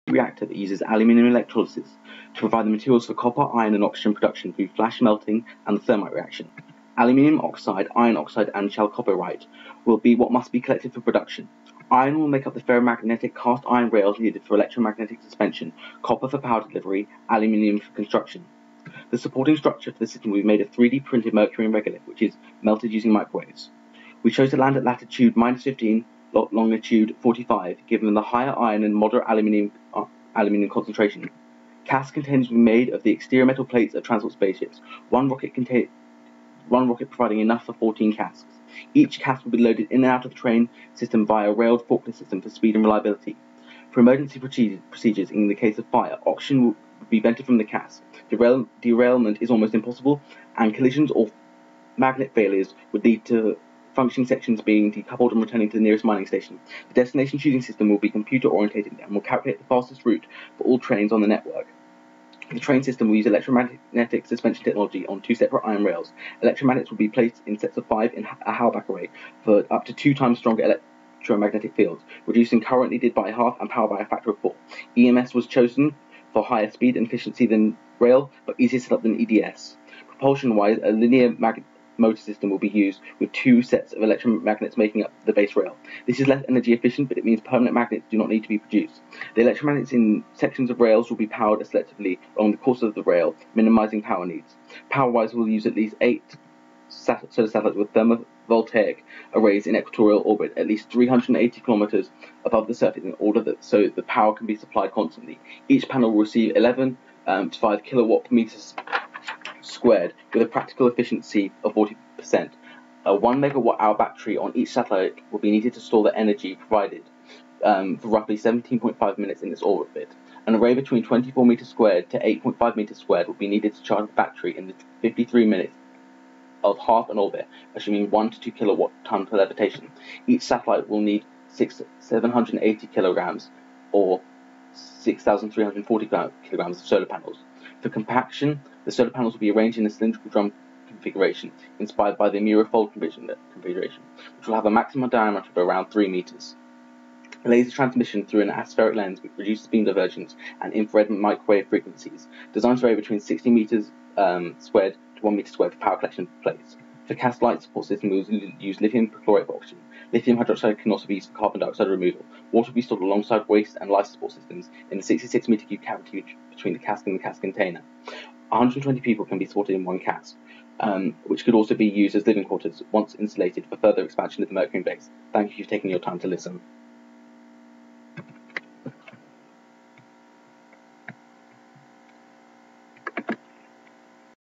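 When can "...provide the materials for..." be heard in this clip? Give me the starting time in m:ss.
0:02.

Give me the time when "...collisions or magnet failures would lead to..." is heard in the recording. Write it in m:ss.
0:50.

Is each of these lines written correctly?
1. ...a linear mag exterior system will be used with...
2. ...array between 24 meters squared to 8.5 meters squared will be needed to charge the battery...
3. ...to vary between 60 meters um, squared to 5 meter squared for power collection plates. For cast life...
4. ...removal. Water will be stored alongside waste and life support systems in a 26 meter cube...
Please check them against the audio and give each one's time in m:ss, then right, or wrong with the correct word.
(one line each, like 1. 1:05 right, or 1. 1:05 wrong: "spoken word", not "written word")
1. 1:20 wrong: "motor", not "exterior"
2. 2:00 right
3. 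2:32 wrong: "1", not "5"
4. 2:41 wrong: "66", not "26".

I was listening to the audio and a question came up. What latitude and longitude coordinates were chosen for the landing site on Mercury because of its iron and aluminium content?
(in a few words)
-15, 45.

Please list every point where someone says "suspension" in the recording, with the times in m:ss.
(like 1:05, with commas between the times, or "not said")
0:15, 1:04.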